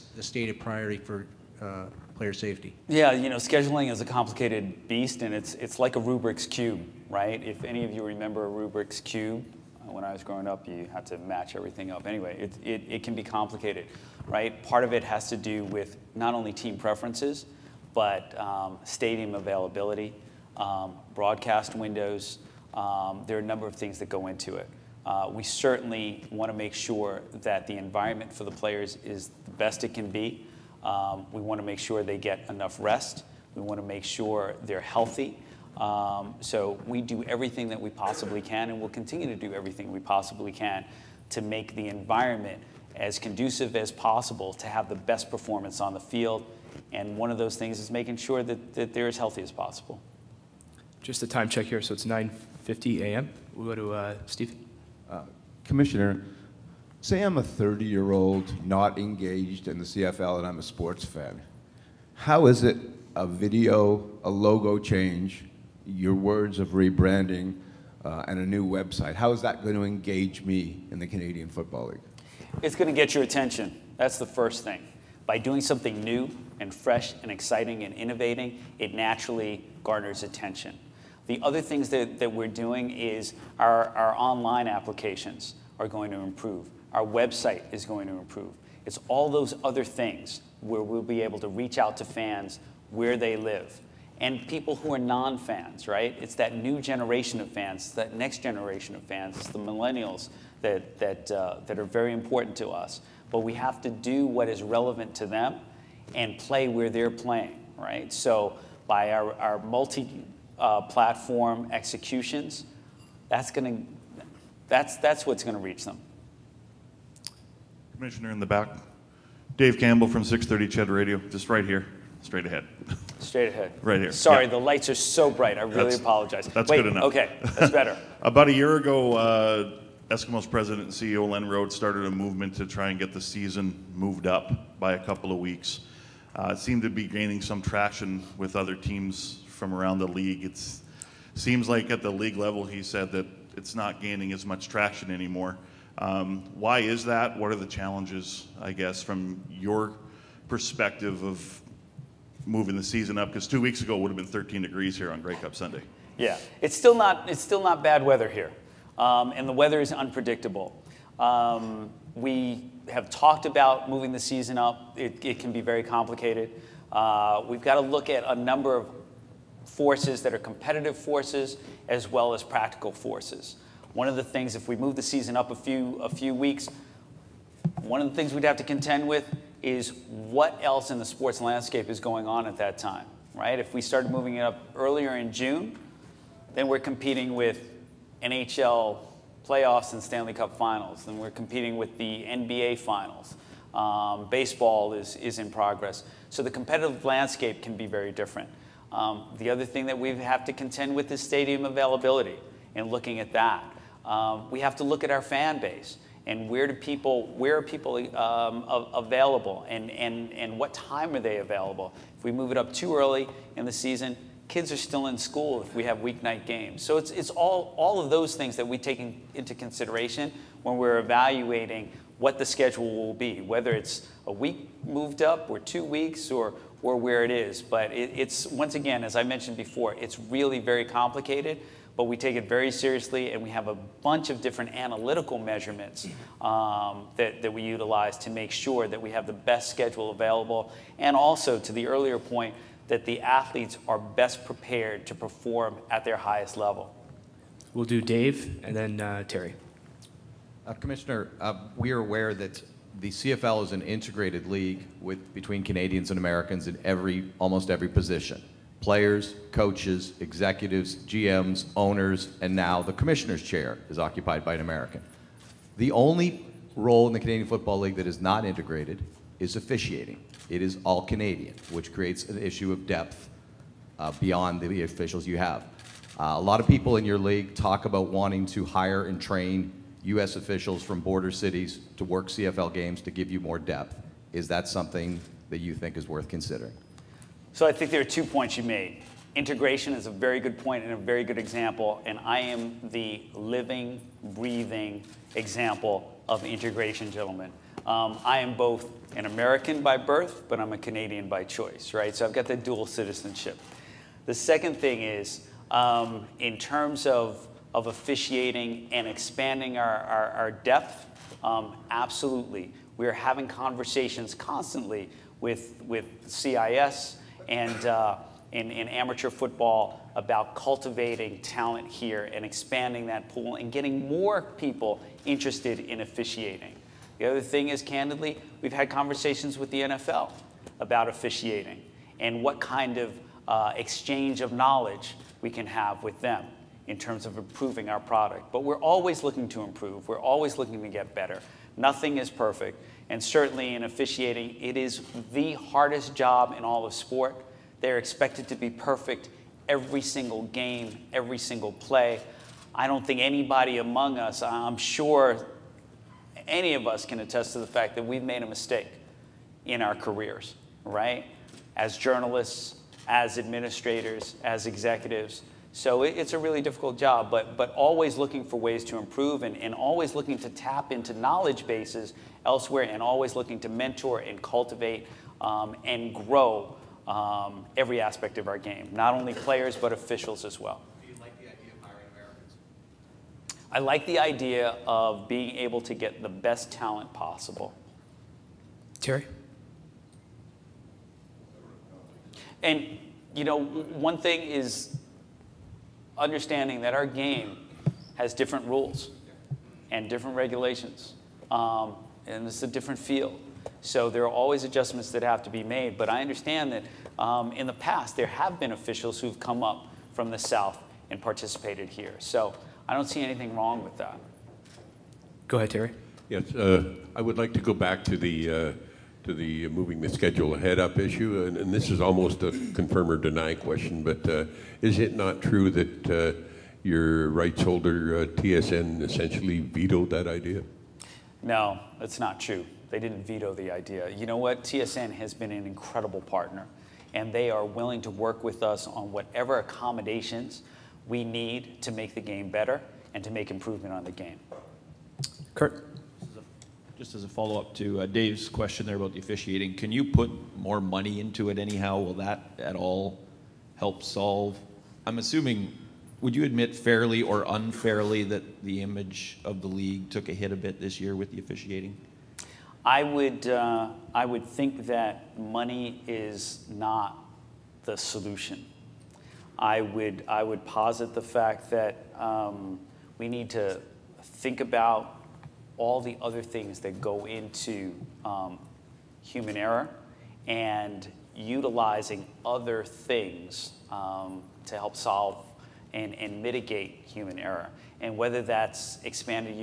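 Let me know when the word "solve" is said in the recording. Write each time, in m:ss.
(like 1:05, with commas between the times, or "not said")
7:34, 8:04.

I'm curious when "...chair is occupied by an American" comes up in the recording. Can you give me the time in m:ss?
4:23.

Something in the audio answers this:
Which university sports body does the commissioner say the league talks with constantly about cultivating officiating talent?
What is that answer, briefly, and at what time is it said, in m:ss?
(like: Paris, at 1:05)
CIS, at 5:16.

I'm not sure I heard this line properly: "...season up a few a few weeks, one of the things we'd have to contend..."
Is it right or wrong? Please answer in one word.
right.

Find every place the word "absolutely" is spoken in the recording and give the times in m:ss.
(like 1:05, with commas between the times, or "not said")
5:11.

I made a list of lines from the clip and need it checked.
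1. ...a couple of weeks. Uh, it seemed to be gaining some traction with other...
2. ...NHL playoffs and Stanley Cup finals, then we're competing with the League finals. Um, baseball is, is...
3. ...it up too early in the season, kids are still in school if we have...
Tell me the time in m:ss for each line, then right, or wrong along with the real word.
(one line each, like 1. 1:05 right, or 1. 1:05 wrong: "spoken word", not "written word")
1. 2:14 right
2. 3:08 wrong: "NBA", not "League"
3. 3:32 right.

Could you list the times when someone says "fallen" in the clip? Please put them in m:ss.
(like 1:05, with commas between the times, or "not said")
not said.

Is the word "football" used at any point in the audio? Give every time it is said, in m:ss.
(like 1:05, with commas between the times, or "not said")
1:11, 4:27, 5:19.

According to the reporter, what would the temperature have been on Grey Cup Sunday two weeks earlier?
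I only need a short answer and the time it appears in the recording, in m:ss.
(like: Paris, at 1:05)
13 degrees, at 2:34.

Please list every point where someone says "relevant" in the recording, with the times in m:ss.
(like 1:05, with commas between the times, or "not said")
1:44.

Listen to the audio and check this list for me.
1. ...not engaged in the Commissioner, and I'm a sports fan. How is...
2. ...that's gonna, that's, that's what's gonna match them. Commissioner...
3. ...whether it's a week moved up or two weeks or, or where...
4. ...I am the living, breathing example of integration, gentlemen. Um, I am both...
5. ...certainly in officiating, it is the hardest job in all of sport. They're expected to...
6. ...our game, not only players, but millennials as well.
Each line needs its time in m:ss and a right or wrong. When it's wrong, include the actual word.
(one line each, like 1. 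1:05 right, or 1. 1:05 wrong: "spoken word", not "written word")
1. 0:58 wrong: "CFL", not "Commissioner"
2. 1:53 wrong: "reach", not "match"
3. 3:43 right
4. 4:52 right
5. 5:43 right
6. 6:18 wrong: "officials", not "millennials".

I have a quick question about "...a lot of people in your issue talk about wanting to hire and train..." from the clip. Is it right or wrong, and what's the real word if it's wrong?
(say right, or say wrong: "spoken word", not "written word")
wrong: "league", not "issue".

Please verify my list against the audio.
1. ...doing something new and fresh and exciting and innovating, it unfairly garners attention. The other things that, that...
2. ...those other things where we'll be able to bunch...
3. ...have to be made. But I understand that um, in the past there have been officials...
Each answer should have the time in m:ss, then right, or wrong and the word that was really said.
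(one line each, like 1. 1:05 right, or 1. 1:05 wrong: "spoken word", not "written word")
1. 1:15 wrong: "naturally", not "unfairly"
2. 1:29 wrong: "reach", not "bunch"
3. 6:45 right.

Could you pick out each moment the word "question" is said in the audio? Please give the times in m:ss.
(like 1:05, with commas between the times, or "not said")
7:03, 7:28.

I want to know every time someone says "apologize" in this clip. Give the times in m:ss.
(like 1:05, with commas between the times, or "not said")
2:05.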